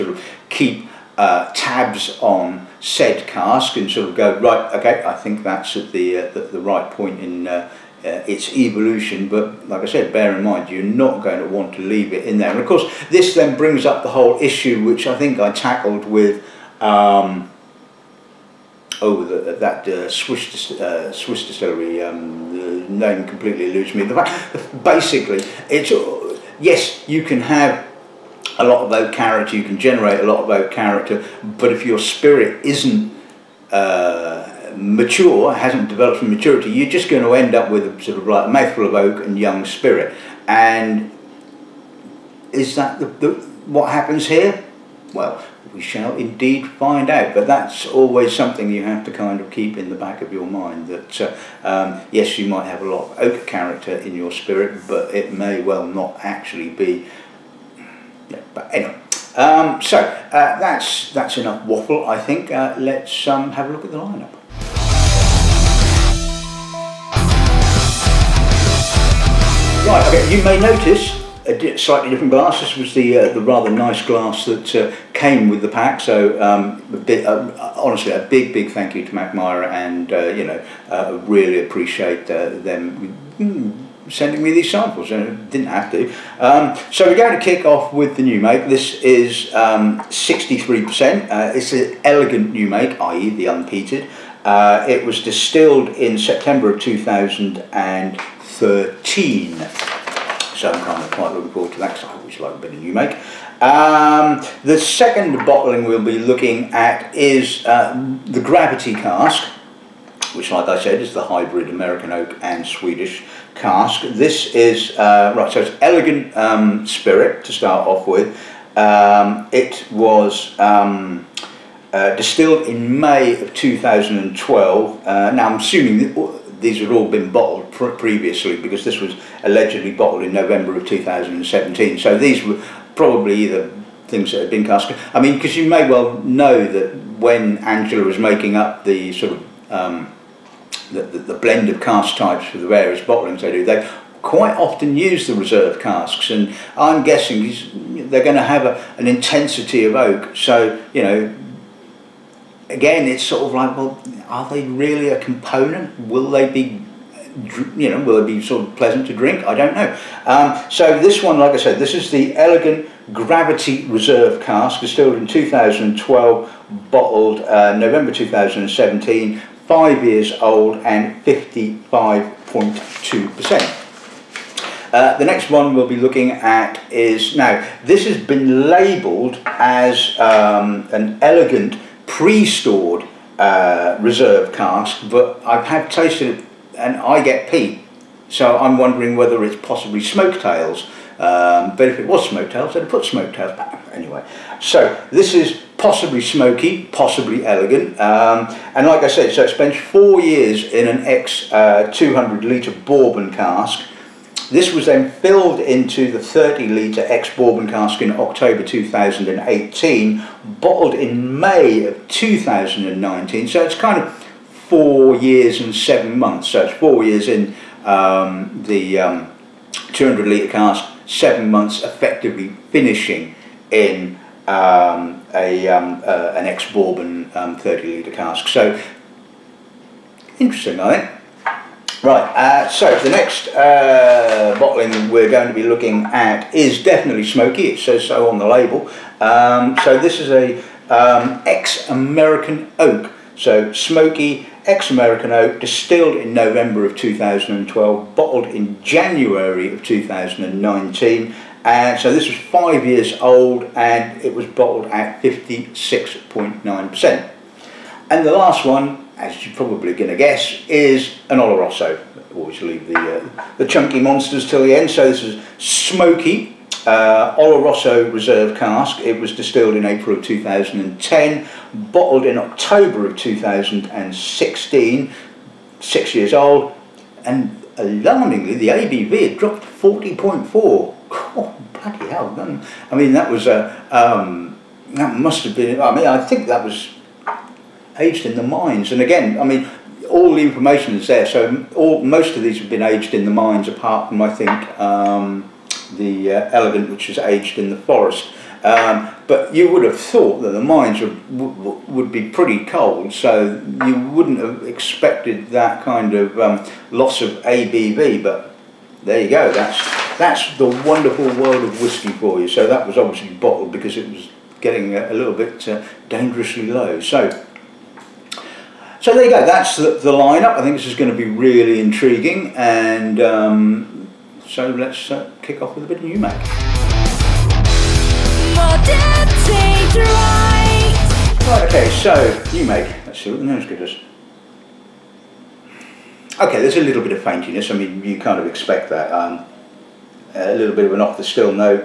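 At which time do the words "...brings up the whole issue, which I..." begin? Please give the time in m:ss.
0:13.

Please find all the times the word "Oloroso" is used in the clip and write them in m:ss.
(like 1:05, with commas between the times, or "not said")
4:21, 4:27.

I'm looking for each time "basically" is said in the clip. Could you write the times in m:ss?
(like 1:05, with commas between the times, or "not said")
0:24.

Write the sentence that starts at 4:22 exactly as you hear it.
Always leave the, uh, the chunky monsters till the end.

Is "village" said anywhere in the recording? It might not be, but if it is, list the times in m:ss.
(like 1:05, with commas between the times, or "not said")
not said.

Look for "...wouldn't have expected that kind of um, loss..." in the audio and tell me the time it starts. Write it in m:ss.
5:04.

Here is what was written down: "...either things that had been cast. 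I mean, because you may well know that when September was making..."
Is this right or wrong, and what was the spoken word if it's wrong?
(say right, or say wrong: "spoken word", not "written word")
wrong: "Angela", not "September".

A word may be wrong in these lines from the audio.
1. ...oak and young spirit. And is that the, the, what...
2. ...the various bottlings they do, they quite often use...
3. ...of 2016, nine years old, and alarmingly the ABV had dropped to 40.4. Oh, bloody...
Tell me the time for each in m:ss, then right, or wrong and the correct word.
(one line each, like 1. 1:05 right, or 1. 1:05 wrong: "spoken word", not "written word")
1. 0:38 right
2. 2:22 right
3. 4:33 wrong: "six", not "nine".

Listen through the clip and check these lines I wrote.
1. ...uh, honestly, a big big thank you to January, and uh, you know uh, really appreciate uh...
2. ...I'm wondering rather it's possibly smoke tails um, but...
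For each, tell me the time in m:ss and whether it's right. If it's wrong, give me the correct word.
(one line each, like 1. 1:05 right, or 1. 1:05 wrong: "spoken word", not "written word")
1. 1:17 wrong: "Mackmyra", not "January"
2. 3:08 wrong: "whether", not "rather".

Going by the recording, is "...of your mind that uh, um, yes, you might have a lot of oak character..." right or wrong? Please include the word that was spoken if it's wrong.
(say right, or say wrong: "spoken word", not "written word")
right.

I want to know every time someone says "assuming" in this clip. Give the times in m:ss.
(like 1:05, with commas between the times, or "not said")
2:05.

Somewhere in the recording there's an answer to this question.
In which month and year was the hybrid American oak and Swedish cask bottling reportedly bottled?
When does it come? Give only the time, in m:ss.
2:10.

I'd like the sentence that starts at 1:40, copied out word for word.
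So I'm kind of quite looking forward to that because I always like a bit of new make.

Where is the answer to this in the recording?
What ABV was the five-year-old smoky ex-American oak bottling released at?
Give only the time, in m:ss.
4:15.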